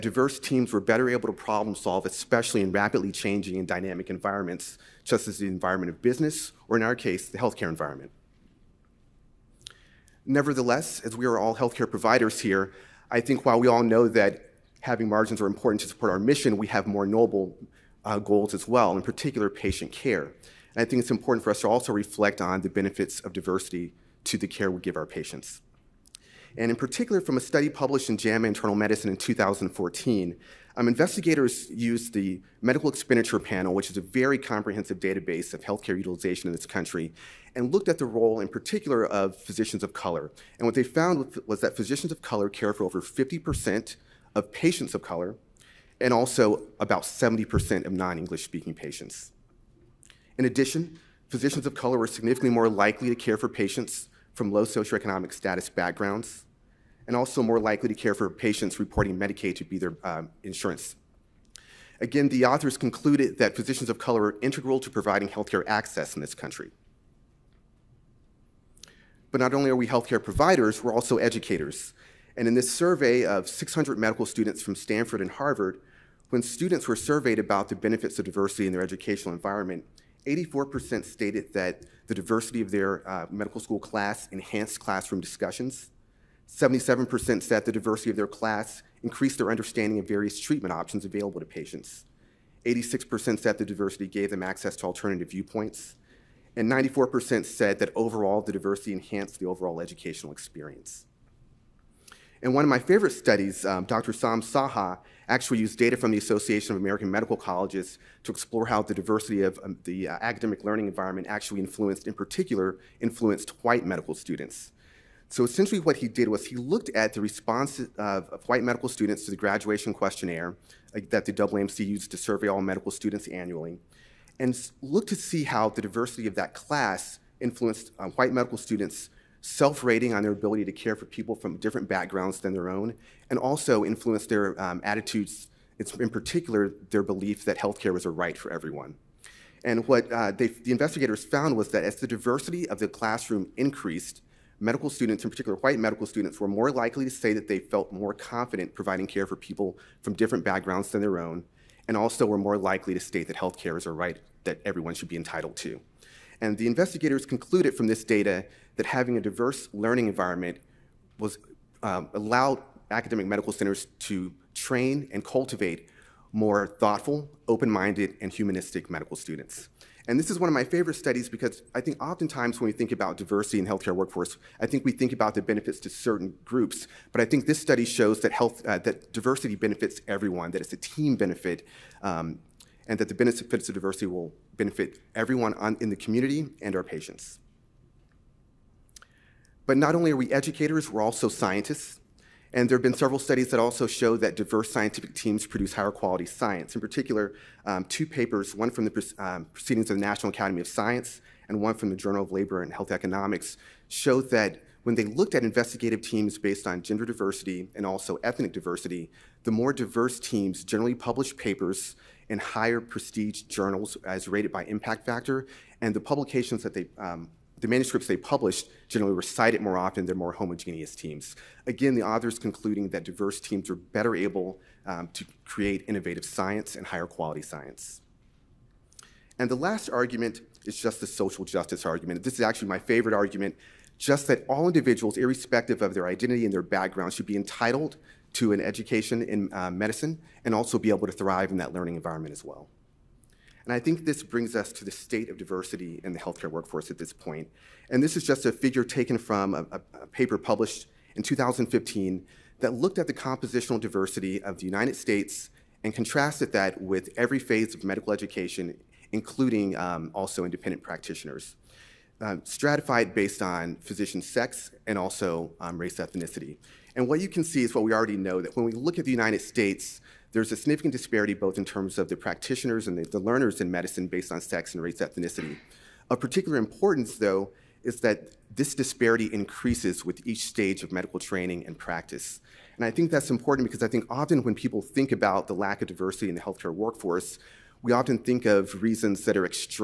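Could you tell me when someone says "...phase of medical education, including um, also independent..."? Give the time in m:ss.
4:17.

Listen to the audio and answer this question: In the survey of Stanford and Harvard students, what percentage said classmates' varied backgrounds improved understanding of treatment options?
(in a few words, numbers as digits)
77%.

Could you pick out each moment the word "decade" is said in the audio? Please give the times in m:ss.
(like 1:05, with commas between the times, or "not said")
not said.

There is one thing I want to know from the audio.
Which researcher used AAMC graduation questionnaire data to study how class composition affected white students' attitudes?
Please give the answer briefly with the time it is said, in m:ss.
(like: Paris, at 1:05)
Sam Saha, at 1:44.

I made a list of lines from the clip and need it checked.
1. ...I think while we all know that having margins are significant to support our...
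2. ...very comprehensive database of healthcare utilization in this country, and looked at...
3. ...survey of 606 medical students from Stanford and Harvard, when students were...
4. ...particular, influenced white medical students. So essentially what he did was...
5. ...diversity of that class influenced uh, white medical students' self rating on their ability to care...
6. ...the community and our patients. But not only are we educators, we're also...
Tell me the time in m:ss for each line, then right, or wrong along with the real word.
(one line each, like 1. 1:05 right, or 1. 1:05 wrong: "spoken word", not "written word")
1. 0:13 wrong: "important", not "significant"
2. 0:34 right
3. 1:12 wrong: "600", not "606"
4. 1:52 right
5. 2:05 right
6. 3:05 right.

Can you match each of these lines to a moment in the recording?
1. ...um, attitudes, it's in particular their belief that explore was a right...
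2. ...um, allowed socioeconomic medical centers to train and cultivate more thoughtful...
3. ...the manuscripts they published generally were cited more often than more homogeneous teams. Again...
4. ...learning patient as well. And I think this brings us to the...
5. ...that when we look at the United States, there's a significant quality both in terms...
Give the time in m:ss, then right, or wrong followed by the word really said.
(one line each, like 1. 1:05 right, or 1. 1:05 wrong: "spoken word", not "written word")
1. 2:14 wrong: "healthcare", not "explore"
2. 2:41 wrong: "academic", not "socioeconomic"
3. 3:37 right
4. 4:01 wrong: "environment", not "patient"
5. 4:28 wrong: "disparity", not "quality".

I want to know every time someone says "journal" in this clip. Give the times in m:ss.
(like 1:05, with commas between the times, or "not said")
3:21, 3:33.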